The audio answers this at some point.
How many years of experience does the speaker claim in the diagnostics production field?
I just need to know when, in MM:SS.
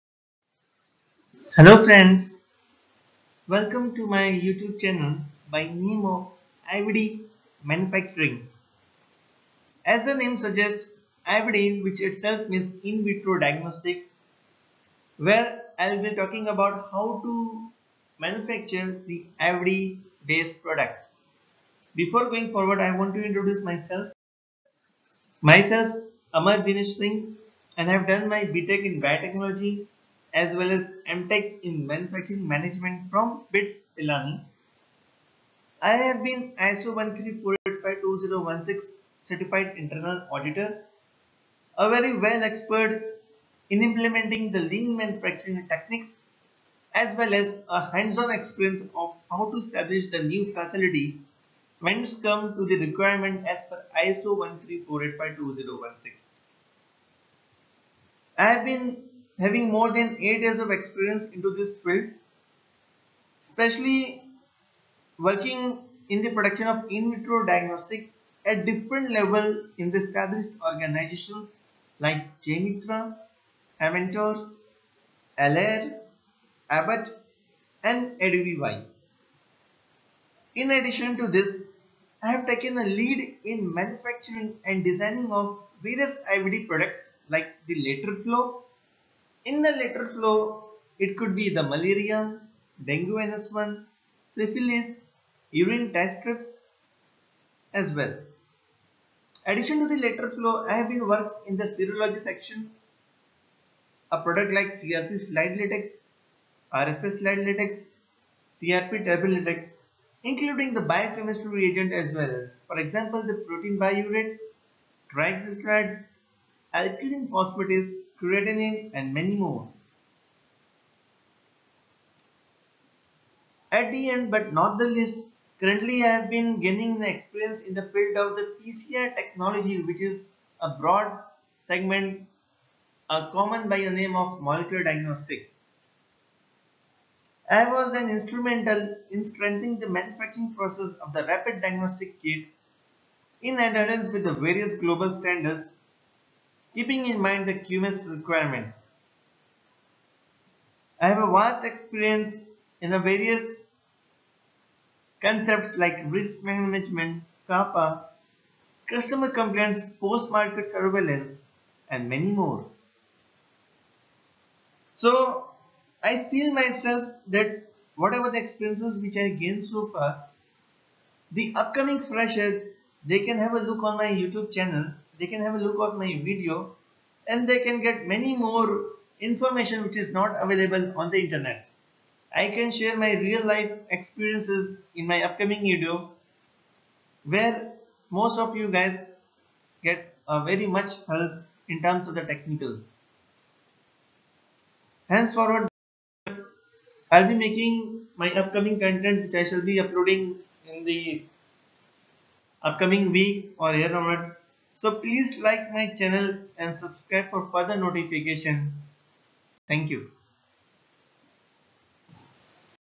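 00:59.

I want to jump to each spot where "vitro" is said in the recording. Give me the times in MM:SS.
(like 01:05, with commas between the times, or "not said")
00:13, 01:07.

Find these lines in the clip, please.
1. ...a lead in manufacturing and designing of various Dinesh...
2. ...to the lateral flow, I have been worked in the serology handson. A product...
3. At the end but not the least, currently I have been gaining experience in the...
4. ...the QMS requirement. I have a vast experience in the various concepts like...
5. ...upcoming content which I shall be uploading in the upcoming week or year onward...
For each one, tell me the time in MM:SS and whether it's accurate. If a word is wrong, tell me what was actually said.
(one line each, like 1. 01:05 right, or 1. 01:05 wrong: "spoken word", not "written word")
1. 01:22 wrong: "IVD", not "Dinesh"
2. 01:39 wrong: "section", not "handson"
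3. 02:03 right
4. 02:27 right
5. 03:18 right.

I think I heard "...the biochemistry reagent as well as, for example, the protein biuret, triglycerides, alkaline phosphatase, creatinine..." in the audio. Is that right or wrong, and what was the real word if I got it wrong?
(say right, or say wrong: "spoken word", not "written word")
right.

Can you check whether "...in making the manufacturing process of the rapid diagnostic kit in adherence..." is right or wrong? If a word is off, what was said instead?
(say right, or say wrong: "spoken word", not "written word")
wrong: "strengthening", not "making".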